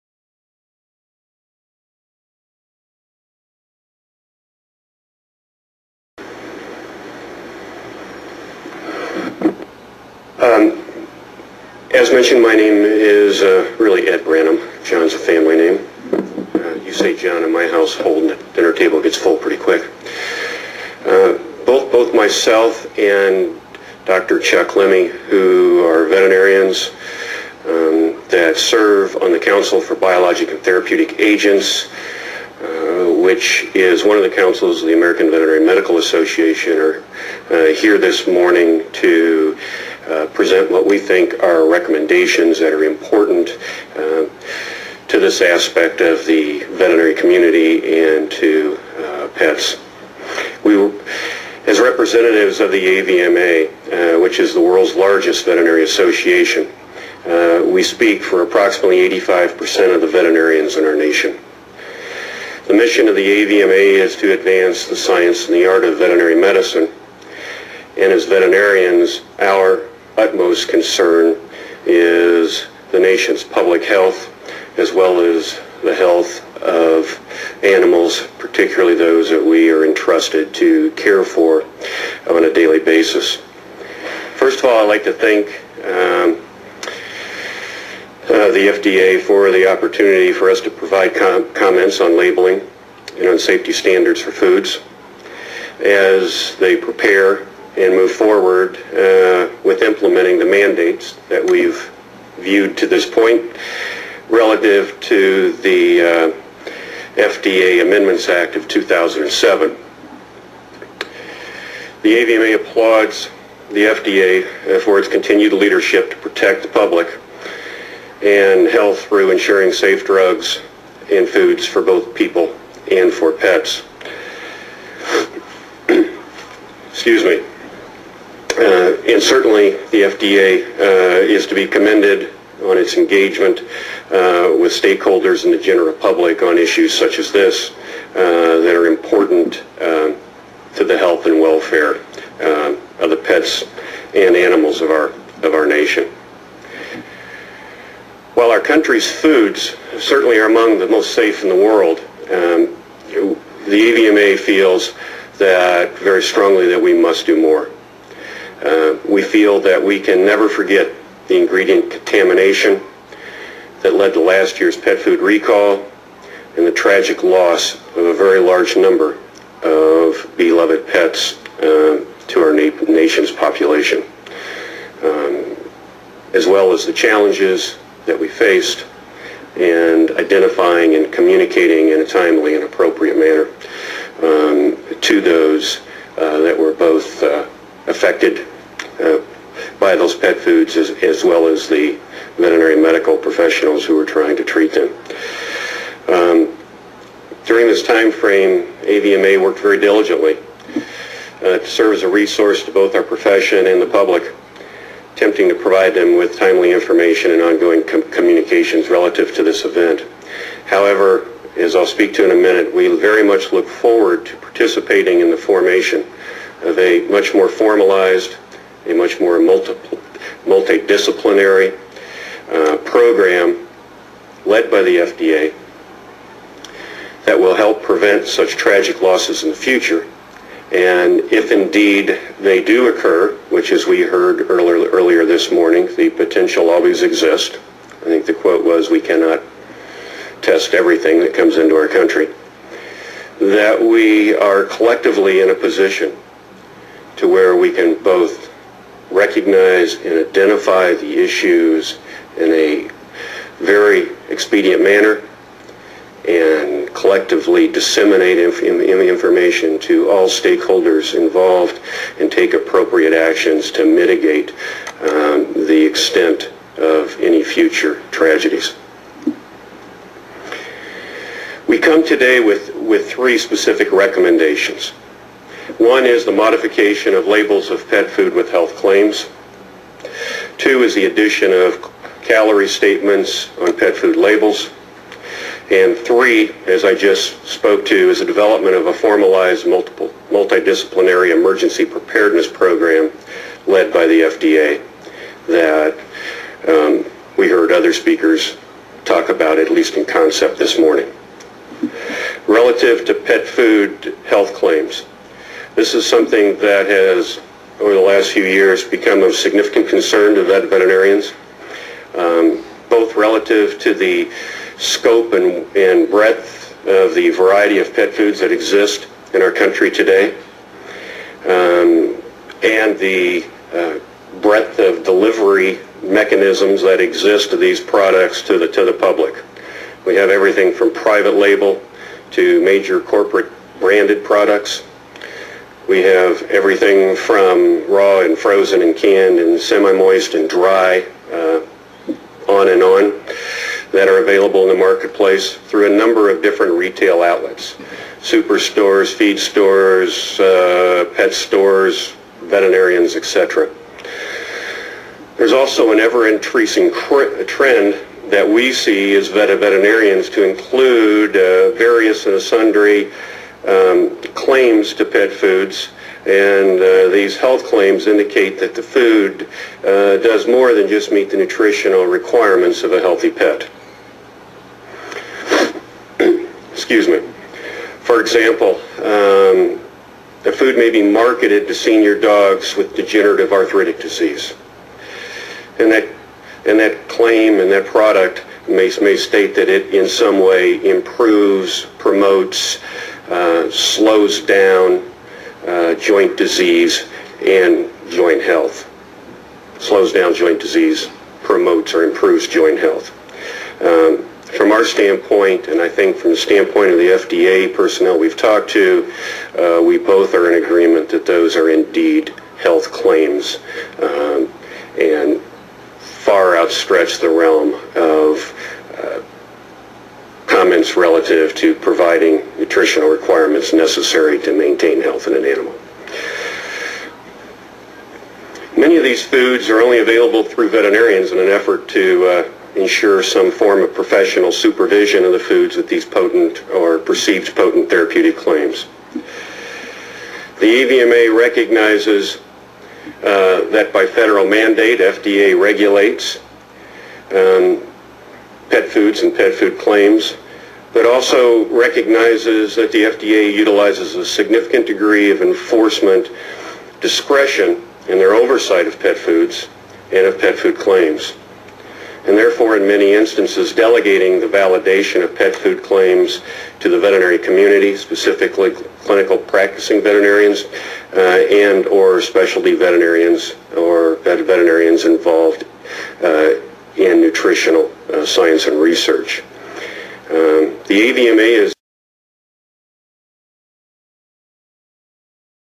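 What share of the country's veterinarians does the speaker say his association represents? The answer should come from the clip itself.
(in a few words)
85%.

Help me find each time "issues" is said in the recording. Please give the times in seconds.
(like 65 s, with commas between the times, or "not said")
136 s, 251 s.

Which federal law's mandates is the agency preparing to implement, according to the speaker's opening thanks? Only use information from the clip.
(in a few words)
FDA Amendments Act of 2007.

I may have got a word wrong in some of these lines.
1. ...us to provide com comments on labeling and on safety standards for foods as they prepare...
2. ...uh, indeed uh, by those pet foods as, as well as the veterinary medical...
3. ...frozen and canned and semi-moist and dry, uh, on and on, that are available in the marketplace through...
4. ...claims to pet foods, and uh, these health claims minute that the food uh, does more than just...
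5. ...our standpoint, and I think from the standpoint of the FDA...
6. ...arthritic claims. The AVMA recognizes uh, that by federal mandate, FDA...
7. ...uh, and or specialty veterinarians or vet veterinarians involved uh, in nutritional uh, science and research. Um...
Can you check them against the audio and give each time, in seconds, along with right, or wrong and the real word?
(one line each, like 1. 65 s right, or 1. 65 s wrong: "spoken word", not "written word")
1. 90 s right
2. 187 s wrong: "affected", not "indeed"
3. 338 s right
4. 364 s wrong: "indicate", not "minute"
5. 404 s right
6. 437 s wrong: "therapeutic", not "arthritic"
7. 471 s right.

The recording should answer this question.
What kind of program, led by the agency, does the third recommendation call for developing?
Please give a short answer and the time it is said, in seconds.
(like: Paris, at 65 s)
emergency preparedness program, at 291 s.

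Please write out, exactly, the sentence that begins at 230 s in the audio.
And if indeed they do occur, which as we heard earlier, earlier this morning, the potential always exists.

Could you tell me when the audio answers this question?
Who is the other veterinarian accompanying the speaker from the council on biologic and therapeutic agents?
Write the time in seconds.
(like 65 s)
24 s.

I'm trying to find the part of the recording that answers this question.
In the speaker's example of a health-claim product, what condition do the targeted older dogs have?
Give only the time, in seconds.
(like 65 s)
382 s.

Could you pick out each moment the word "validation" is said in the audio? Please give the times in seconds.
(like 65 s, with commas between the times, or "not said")
464 s.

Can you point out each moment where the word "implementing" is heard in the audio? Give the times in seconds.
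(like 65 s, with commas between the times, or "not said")
99 s.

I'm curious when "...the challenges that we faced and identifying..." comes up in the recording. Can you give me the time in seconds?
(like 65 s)
176 s.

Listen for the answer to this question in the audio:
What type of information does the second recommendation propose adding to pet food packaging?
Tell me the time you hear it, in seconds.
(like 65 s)
282 s.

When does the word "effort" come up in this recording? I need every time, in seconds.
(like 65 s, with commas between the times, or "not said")
431 s.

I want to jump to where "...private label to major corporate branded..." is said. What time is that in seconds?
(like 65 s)
330 s.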